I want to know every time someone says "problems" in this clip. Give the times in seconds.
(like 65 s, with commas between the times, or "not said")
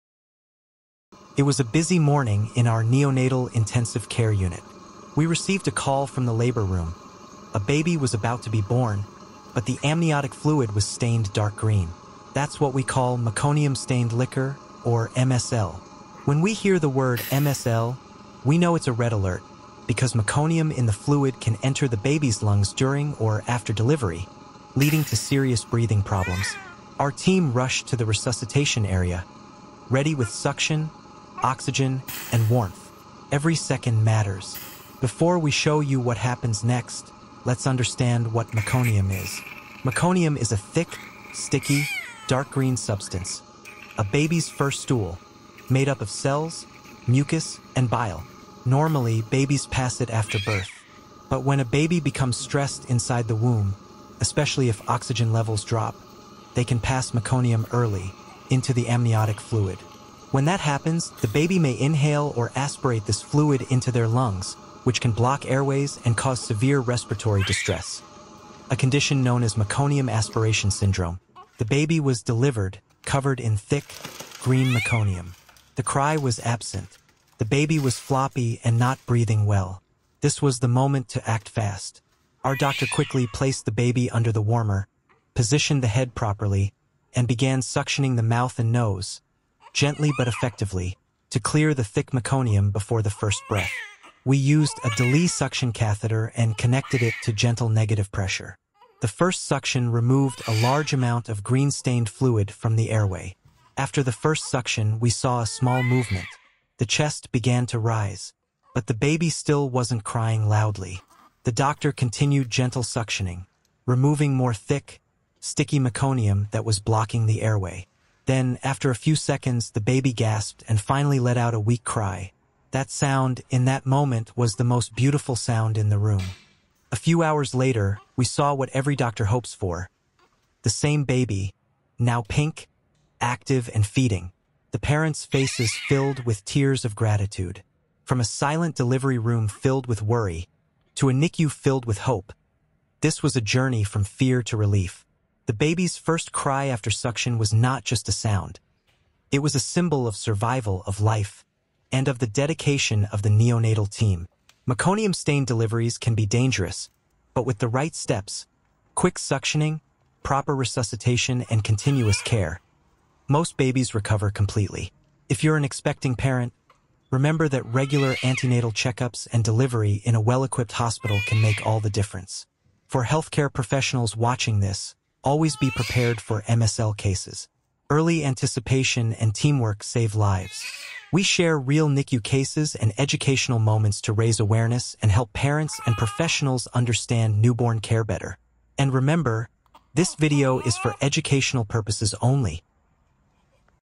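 26 s.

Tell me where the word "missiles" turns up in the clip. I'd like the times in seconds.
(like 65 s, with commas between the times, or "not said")
not said.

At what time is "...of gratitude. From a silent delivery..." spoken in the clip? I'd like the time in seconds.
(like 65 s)
136 s.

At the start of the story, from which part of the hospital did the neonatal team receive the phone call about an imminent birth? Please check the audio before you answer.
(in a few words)
Labor room.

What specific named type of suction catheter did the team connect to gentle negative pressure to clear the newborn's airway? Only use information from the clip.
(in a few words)
DeLee suction catheter.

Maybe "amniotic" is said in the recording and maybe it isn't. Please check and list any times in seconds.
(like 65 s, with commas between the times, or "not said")
9 s, 58 s.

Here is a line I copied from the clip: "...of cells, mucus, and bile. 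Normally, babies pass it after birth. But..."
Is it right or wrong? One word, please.
right.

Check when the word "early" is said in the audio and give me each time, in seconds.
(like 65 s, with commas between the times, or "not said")
57 s, 177 s.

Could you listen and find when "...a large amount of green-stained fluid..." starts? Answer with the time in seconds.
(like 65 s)
100 s.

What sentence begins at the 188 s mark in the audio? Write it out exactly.
And remember, this video is for educational purposes only.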